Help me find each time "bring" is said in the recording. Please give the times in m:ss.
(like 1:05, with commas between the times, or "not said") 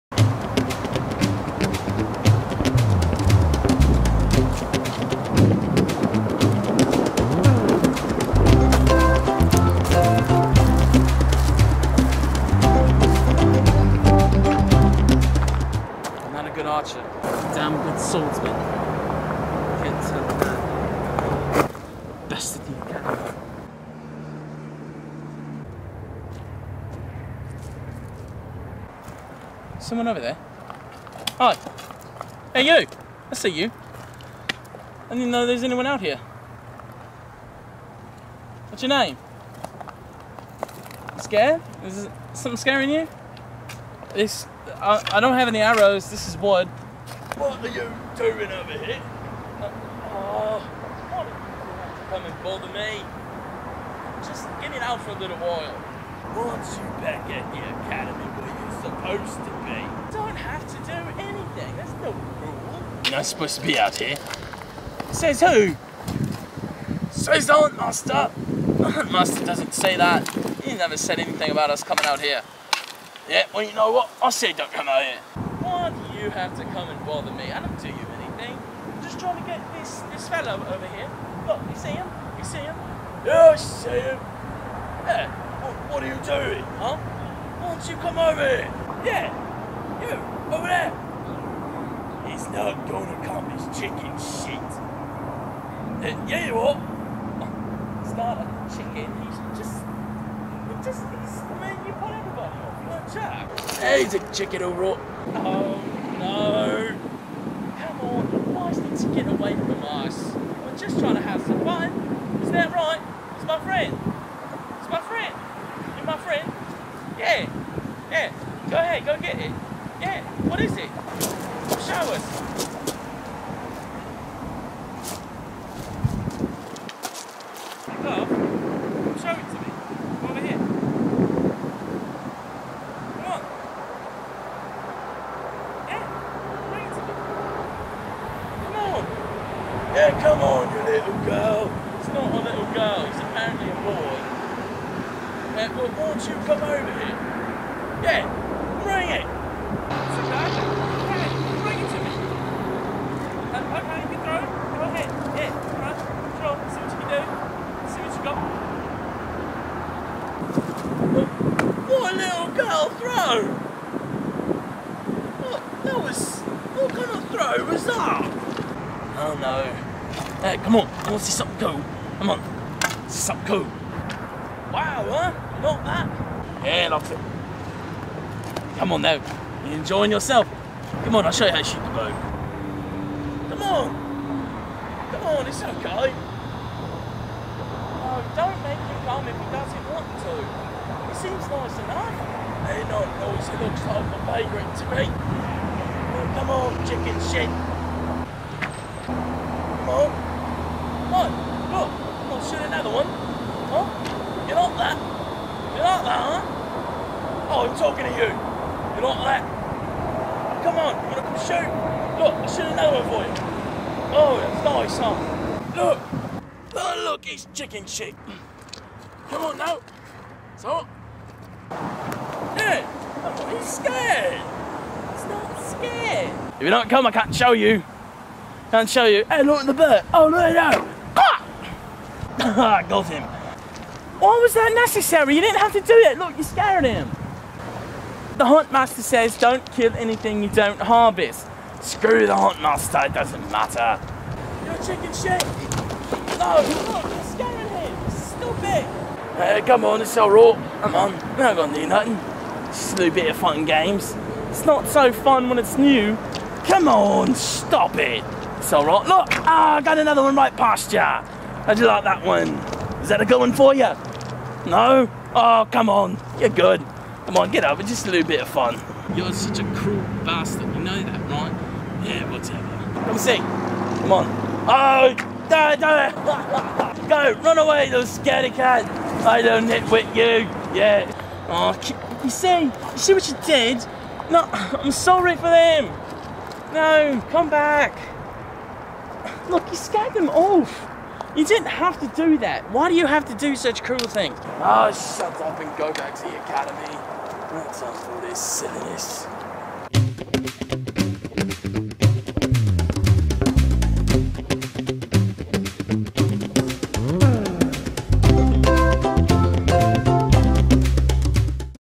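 2:16, 2:28.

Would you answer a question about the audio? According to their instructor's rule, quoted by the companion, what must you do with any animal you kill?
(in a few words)
harvest.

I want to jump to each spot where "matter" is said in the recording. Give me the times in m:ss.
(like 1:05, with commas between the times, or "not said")
4:03.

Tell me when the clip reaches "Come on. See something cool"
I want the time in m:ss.
2:52.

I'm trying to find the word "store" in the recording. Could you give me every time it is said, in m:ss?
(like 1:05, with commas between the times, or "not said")
not said.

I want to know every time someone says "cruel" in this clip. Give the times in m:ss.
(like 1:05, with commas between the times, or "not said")
4:29, 4:53.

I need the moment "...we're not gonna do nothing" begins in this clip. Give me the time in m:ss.
4:11.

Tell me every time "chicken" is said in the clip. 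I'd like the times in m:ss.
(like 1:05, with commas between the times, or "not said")
1:33, 1:38, 1:44, 3:16, 3:37, 4:04.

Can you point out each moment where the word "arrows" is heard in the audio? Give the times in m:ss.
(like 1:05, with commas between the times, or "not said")
0:45.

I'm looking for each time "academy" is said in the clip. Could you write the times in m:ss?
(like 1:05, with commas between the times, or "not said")
0:57, 4:56.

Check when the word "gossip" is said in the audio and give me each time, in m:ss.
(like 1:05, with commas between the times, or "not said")
not said.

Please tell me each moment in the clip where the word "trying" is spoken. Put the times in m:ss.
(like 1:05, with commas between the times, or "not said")
1:19, 1:50.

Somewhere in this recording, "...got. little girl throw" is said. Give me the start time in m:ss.
2:42.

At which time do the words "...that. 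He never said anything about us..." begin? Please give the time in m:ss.
1:09.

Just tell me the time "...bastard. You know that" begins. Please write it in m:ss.
4:30.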